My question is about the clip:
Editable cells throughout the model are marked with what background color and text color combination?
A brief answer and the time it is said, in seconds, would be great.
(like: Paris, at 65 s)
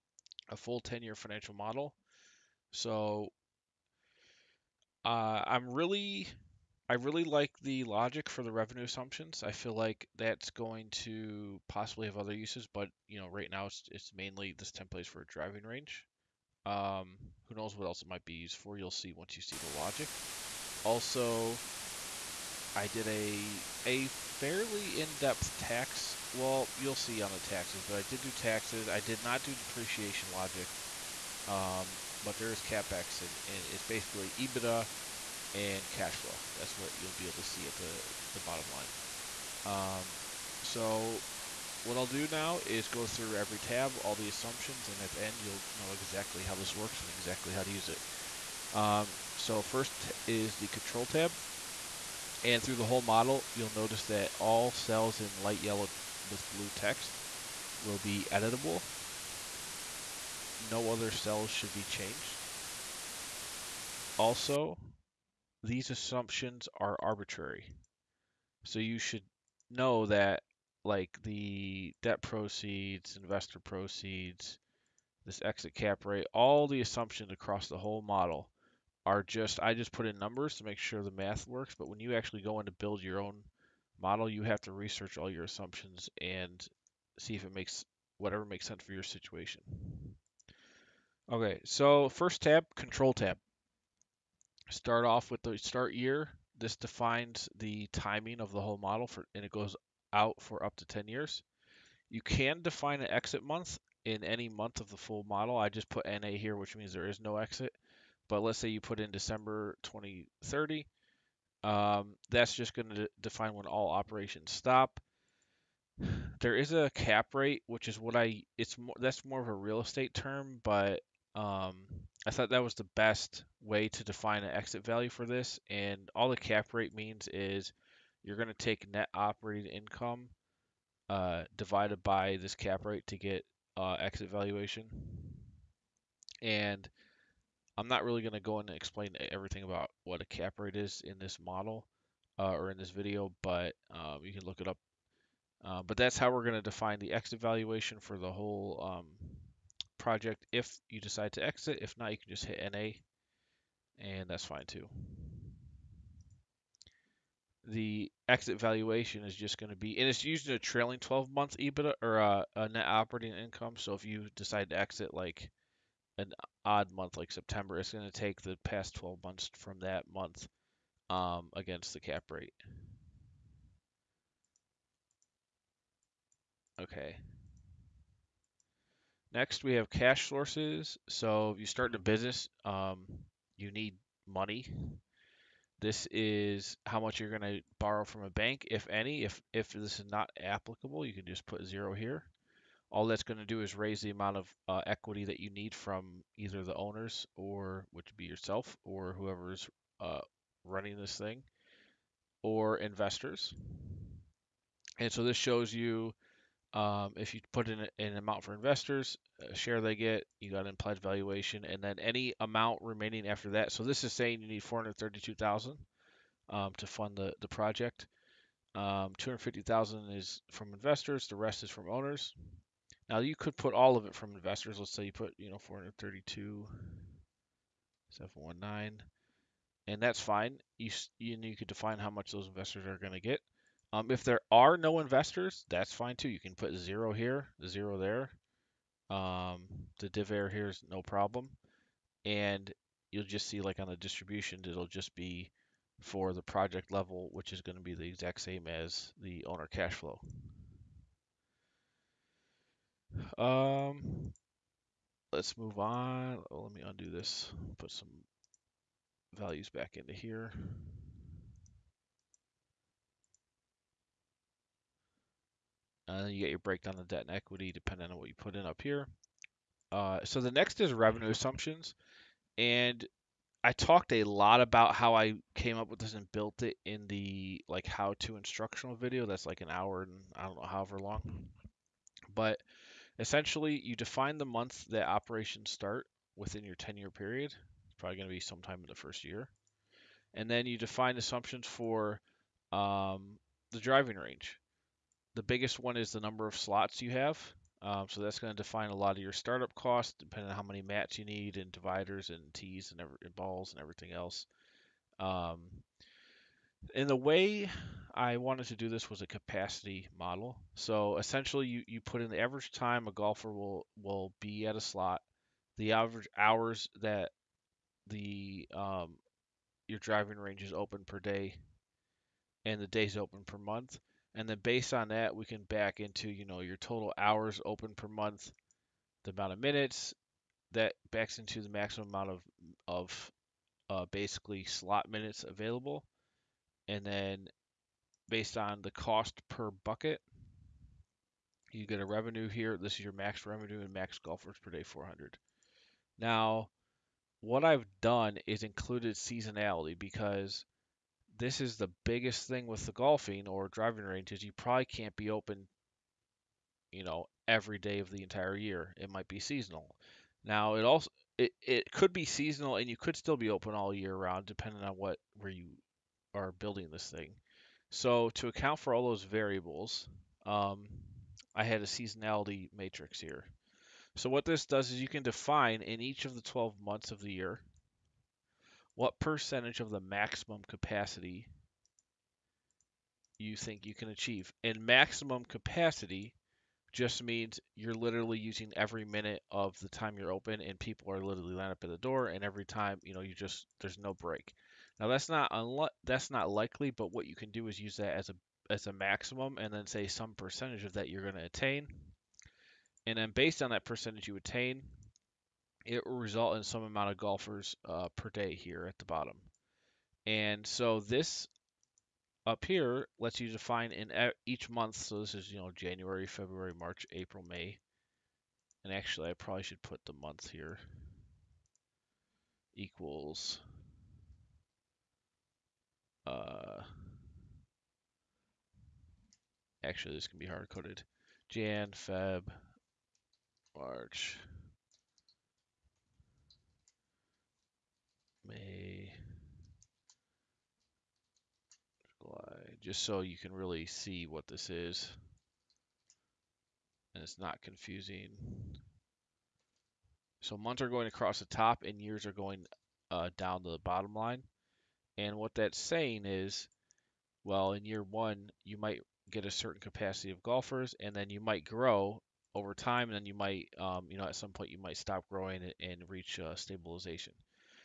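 Light yellow with blue text, at 55 s.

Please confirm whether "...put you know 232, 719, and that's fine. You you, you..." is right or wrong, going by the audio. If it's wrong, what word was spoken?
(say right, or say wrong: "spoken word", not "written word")
wrong: "432", not "232".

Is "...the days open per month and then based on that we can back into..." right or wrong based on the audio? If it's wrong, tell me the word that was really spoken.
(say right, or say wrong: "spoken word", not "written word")
right.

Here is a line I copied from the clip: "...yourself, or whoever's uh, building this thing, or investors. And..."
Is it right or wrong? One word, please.
wrong.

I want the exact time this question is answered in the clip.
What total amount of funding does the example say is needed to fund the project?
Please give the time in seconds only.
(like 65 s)
214 s.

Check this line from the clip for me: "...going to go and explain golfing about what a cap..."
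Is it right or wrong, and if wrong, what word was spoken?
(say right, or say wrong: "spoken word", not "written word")
wrong: "everything", not "golfing".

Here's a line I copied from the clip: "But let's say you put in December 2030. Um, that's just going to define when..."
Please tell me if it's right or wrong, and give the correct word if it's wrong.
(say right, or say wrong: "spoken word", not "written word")
right.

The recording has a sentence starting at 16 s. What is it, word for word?
Um, who knows what else it might be used for?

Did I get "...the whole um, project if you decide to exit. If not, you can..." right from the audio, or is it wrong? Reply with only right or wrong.
right.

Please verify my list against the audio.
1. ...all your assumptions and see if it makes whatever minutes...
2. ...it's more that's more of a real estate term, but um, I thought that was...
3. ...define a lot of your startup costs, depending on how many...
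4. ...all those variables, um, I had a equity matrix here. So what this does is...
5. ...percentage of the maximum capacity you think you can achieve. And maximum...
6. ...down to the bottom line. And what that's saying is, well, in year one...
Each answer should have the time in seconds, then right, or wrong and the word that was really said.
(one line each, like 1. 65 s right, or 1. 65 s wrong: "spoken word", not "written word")
1. 85 s wrong: "makes", not "minutes"
2. 118 s right
3. 298 s right
4. 368 s wrong: "seasonality", not "equity"
5. 379 s right
6. 453 s right.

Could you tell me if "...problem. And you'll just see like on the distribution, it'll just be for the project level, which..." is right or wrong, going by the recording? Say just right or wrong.
right.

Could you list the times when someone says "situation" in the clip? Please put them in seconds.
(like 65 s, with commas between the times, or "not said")
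89 s.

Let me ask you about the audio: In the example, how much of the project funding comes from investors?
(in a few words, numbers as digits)
250,000.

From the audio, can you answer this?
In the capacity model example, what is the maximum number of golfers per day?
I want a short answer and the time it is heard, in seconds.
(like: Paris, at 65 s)
400, at 344 s.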